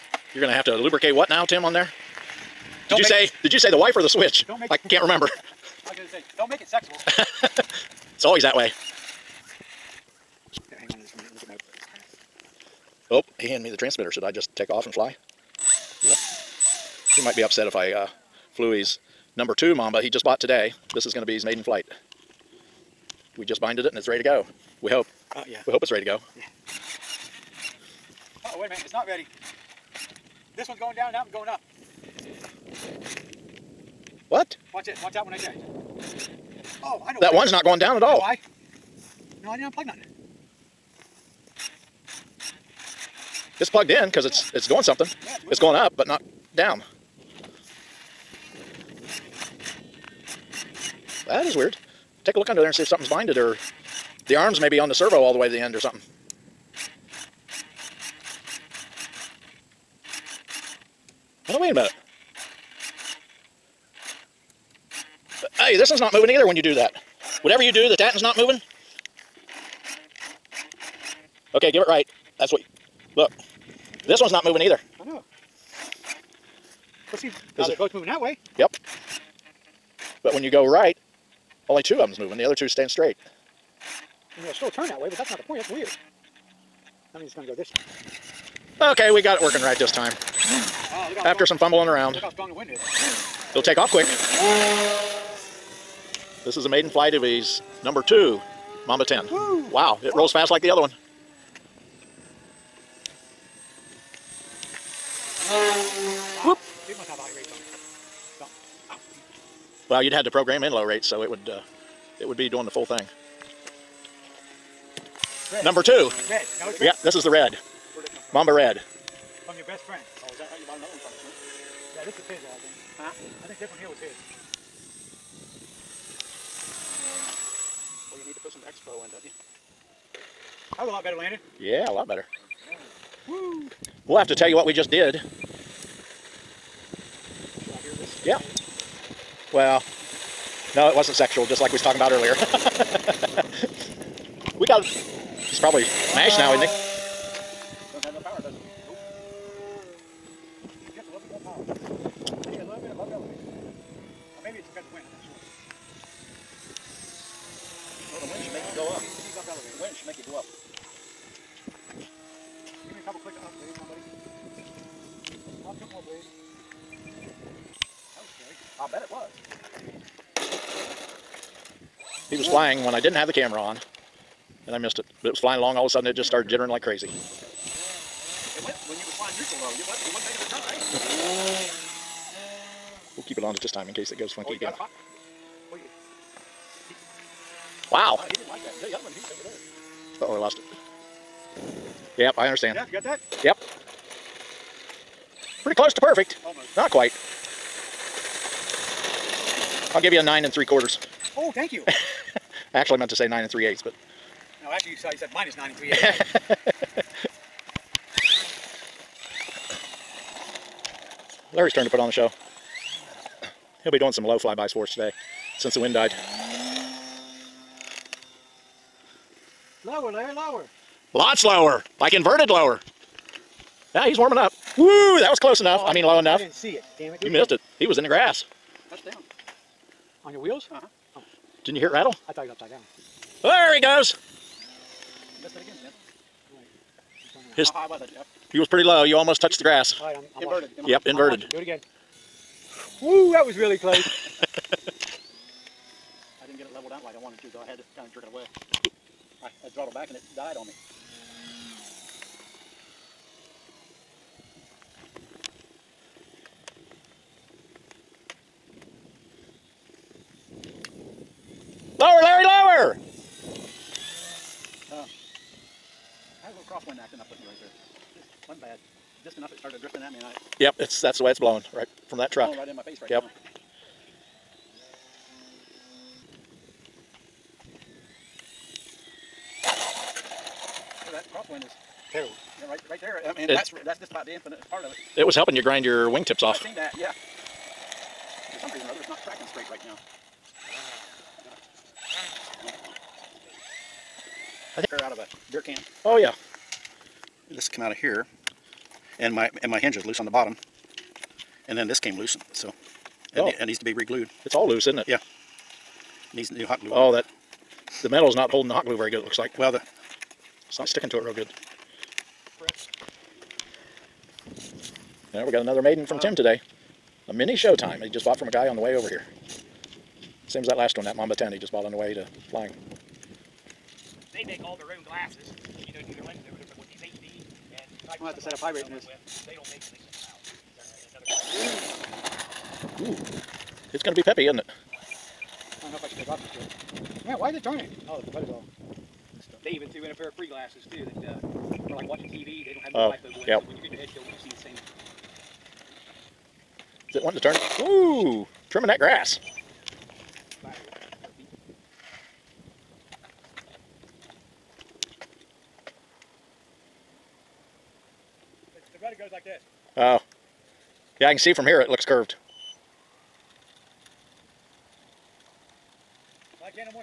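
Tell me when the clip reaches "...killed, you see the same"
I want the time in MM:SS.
05:44.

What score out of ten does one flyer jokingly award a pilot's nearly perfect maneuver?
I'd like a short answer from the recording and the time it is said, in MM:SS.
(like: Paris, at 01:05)
9 3/4, at 03:20.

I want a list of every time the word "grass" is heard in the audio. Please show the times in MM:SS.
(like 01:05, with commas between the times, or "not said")
03:48, 03:59, 05:48.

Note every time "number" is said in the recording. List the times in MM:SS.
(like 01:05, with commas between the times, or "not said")
00:19, 01:37, 01:55.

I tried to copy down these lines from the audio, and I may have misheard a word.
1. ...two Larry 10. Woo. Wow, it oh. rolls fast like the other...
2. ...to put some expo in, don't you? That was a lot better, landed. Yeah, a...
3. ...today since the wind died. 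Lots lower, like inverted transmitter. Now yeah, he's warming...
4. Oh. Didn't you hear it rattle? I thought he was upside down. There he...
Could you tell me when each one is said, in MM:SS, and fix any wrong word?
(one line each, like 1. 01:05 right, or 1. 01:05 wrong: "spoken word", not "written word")
1. 01:38 wrong: "Mamba", not "Larry"
2. 02:08 right
3. 03:34 wrong: "lower", not "transmitter"
4. 03:51 right.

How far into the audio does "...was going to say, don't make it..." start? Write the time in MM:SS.
00:05.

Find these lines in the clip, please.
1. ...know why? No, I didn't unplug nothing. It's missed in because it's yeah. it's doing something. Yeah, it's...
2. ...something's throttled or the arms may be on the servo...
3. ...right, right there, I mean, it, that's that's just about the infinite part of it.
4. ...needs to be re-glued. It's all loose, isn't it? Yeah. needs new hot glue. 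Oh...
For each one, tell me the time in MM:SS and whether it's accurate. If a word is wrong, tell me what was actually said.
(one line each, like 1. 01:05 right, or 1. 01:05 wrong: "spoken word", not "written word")
1. 00:38 wrong: "plugged", not "missed"
2. 00:52 wrong: "binded", not "throttled"
3. 04:42 right
4. 05:03 right.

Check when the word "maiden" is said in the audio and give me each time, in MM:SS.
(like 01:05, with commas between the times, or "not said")
00:21, 01:36, 05:15.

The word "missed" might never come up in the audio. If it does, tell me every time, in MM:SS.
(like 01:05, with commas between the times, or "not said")
02:54, 03:47, 03:55.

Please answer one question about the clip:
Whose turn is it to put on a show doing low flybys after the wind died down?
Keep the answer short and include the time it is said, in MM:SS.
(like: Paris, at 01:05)
Larry, at 03:31.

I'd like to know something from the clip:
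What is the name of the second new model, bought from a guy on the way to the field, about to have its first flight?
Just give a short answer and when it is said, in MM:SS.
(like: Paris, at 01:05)
Mini Showtime, at 05:17.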